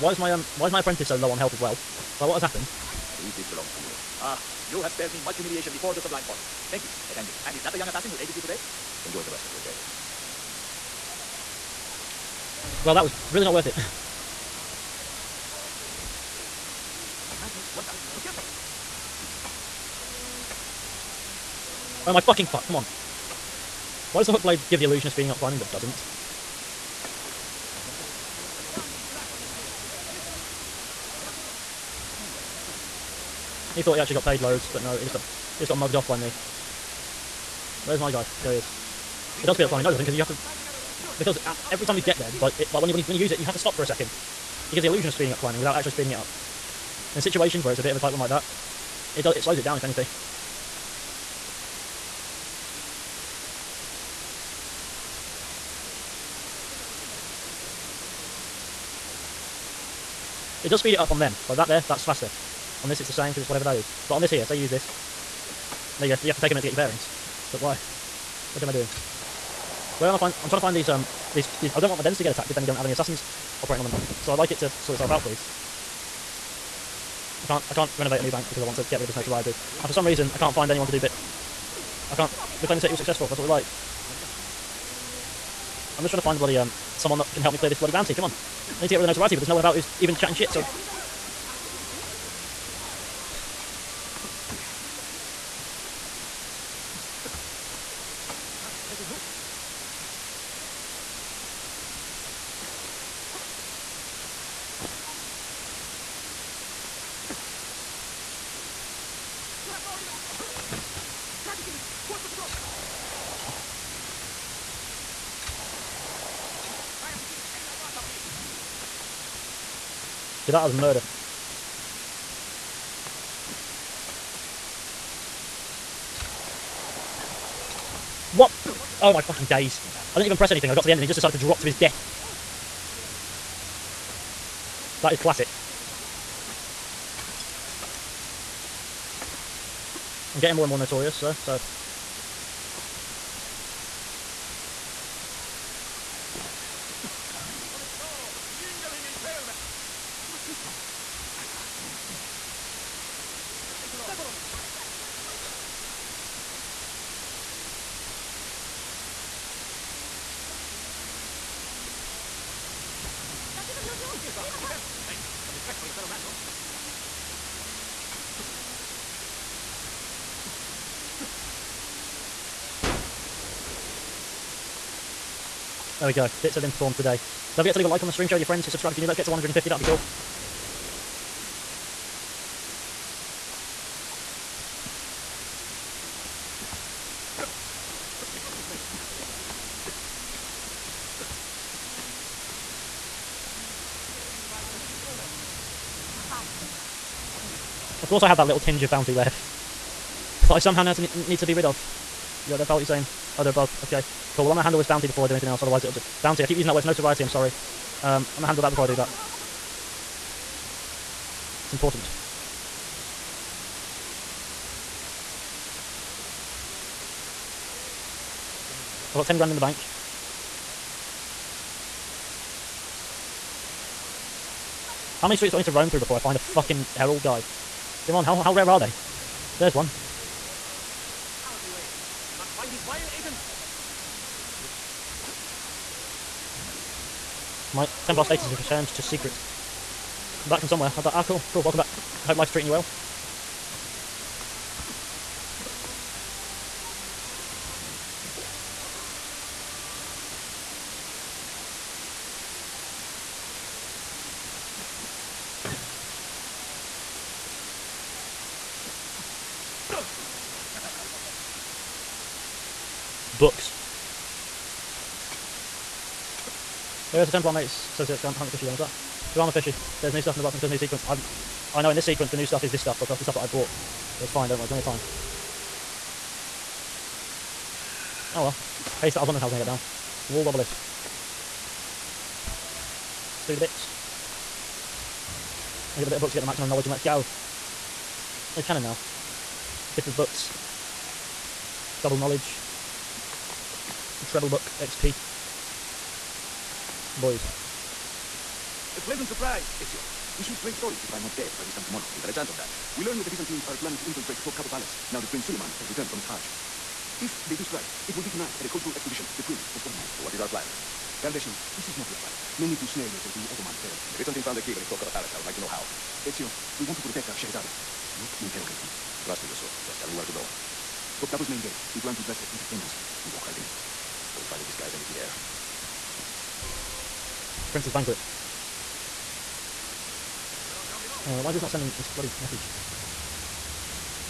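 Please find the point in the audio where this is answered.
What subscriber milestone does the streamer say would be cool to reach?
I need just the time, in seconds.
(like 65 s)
179 s.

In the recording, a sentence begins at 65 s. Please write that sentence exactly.
There you go, you have to take a minute to get your bearings.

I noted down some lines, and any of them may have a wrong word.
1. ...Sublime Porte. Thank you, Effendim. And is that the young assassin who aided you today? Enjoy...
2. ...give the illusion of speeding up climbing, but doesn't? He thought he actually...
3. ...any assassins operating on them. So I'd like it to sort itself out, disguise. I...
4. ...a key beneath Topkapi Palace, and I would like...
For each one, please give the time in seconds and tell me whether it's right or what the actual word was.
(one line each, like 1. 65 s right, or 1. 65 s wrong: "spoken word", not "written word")
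1. 5 s right
2. 24 s right
3. 72 s wrong: "please", not "disguise"
4. 314 s right.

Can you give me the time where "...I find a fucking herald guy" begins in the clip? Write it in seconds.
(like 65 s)
226 s.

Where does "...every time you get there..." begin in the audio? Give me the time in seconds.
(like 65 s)
41 s.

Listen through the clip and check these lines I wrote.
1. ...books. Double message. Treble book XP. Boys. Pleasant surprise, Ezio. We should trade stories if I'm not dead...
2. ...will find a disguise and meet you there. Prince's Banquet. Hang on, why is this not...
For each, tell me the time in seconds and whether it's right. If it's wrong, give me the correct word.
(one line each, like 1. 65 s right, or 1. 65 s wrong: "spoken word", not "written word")
1. 290 s wrong: "knowledge", not "message"
2. 324 s right.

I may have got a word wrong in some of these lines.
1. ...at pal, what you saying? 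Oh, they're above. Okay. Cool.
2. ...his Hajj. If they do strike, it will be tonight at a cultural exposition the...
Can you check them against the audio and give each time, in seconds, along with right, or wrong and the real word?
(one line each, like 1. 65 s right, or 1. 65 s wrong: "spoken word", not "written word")
1. 202 s right
2. 306 s right.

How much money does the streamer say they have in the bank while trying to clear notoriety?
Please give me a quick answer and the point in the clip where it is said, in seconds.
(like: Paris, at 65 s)
10 grand, at 219 s.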